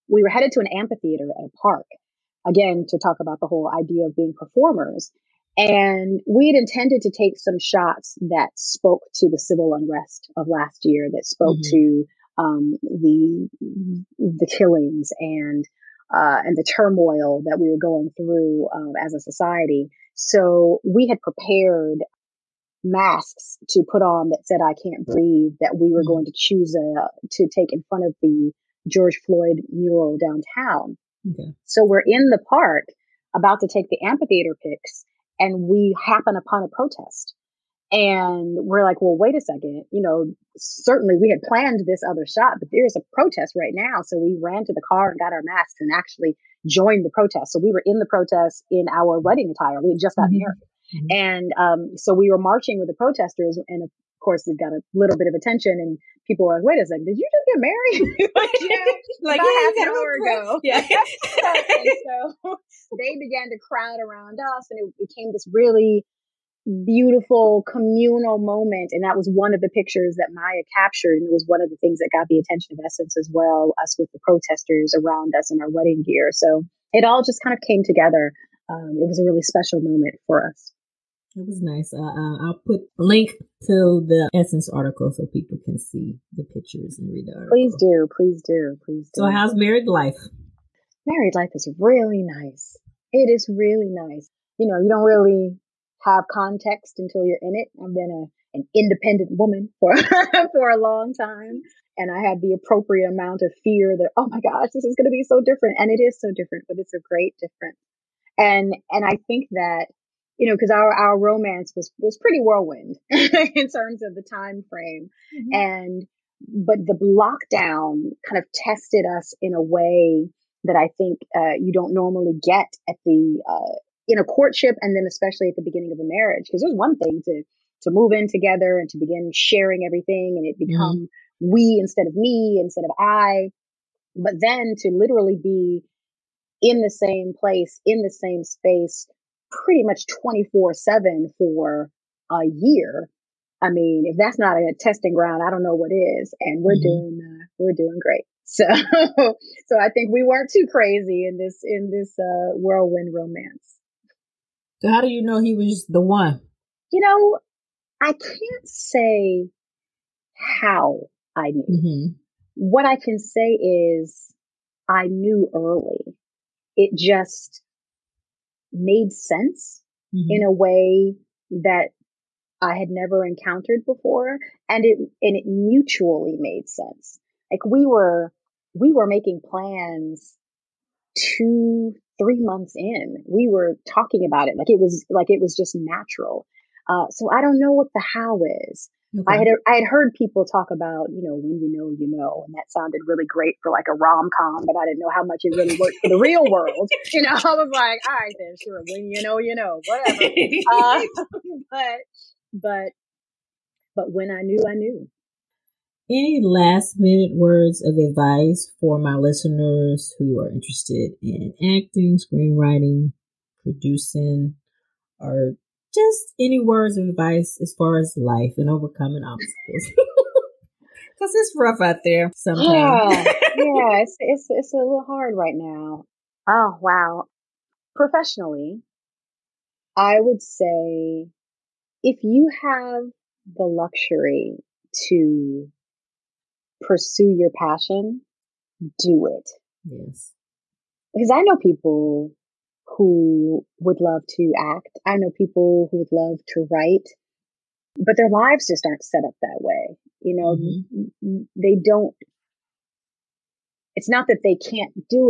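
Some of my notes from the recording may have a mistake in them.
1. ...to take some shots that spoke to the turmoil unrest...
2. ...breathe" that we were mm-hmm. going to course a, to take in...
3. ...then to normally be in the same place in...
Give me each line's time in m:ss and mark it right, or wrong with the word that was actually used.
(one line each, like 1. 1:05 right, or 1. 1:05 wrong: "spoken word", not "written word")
1. 0:07 wrong: "civil", not "turmoil"
2. 0:25 wrong: "choose", not "course"
3. 2:14 wrong: "literally", not "normally".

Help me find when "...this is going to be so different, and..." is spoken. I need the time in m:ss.
1:44.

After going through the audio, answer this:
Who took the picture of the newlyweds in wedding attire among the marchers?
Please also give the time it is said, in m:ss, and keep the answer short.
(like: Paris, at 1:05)
Maya, at 1:10.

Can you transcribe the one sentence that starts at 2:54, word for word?
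And it, and it mutually made sense.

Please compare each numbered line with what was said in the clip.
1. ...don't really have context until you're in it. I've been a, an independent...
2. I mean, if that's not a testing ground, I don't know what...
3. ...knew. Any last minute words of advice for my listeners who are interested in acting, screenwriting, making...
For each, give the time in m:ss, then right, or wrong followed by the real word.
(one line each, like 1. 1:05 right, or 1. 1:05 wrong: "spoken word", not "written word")
1. 1:34 right
2. 2:23 right
3. 3:24 wrong: "producing", not "making".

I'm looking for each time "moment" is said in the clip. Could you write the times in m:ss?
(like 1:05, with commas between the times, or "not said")
1:08, 1:19.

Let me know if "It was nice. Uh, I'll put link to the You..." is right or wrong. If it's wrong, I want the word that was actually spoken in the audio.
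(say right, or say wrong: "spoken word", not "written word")
wrong: "Essence", not "You".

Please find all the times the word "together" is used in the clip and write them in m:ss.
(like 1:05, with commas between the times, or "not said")
1:17, 2:08.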